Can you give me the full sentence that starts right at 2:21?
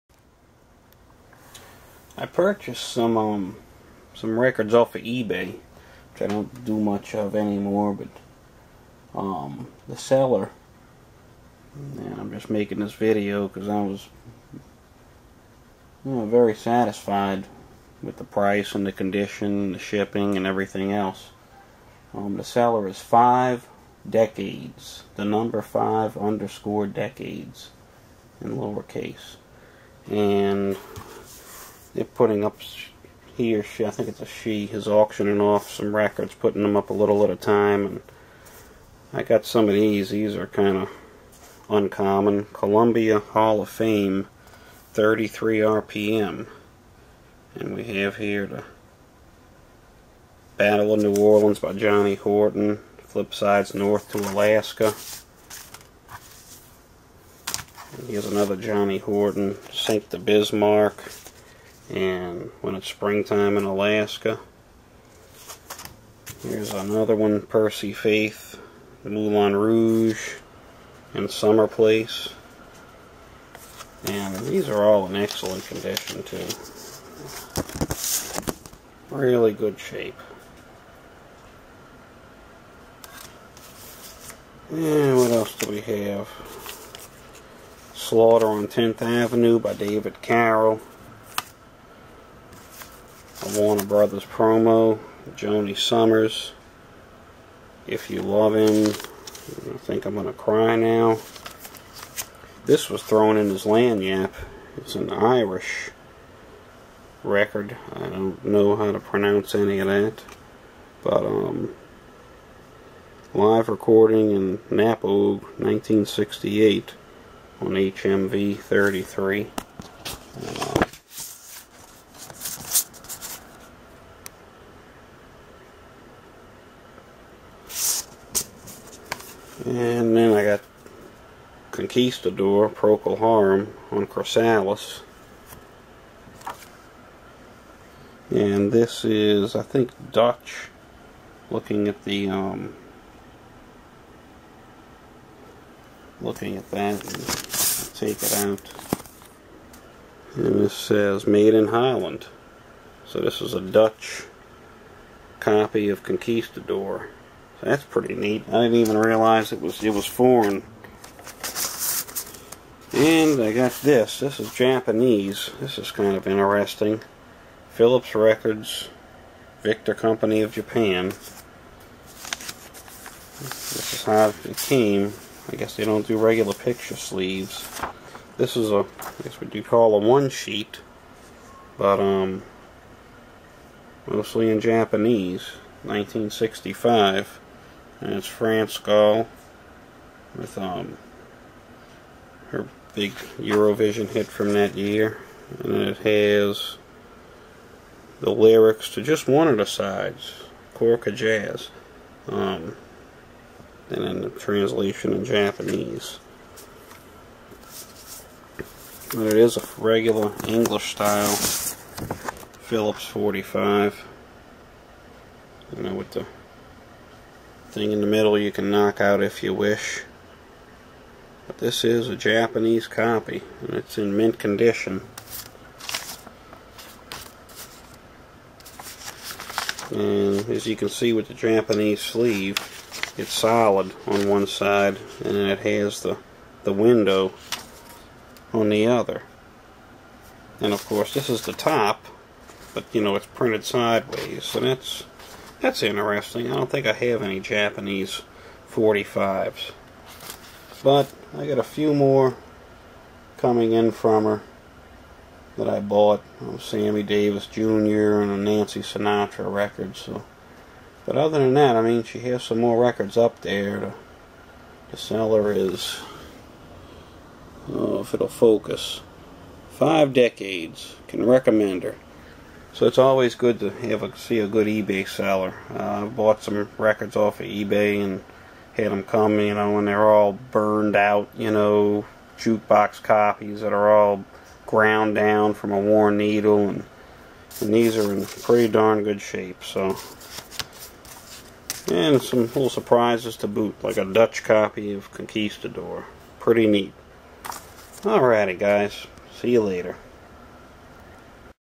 Looking at the, um, looking at that, take it out.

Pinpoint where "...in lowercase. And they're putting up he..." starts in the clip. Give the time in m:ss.
0:28.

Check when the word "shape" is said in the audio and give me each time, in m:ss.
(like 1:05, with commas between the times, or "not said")
1:19, 4:49.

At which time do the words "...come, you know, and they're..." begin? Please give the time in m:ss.
4:39.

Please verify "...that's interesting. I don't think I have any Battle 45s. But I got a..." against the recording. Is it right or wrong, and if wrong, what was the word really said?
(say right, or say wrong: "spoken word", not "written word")
wrong: "Japanese", not "Battle".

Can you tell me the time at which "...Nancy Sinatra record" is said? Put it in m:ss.
4:18.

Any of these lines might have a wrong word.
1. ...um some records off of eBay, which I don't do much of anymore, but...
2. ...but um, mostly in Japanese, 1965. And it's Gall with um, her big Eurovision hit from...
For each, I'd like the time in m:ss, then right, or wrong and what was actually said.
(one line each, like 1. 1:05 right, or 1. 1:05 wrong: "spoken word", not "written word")
1. 0:03 right
2. 3:01 right.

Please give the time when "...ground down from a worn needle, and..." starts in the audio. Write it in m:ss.
4:44.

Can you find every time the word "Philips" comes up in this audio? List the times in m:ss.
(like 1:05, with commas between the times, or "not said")
2:47, 3:32.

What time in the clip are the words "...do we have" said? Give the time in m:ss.
1:25.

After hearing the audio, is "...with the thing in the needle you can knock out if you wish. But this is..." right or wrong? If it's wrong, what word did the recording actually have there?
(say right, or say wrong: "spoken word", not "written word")
wrong: "middle", not "needle".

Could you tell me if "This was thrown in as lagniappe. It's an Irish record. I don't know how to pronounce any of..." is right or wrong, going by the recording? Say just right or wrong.
right.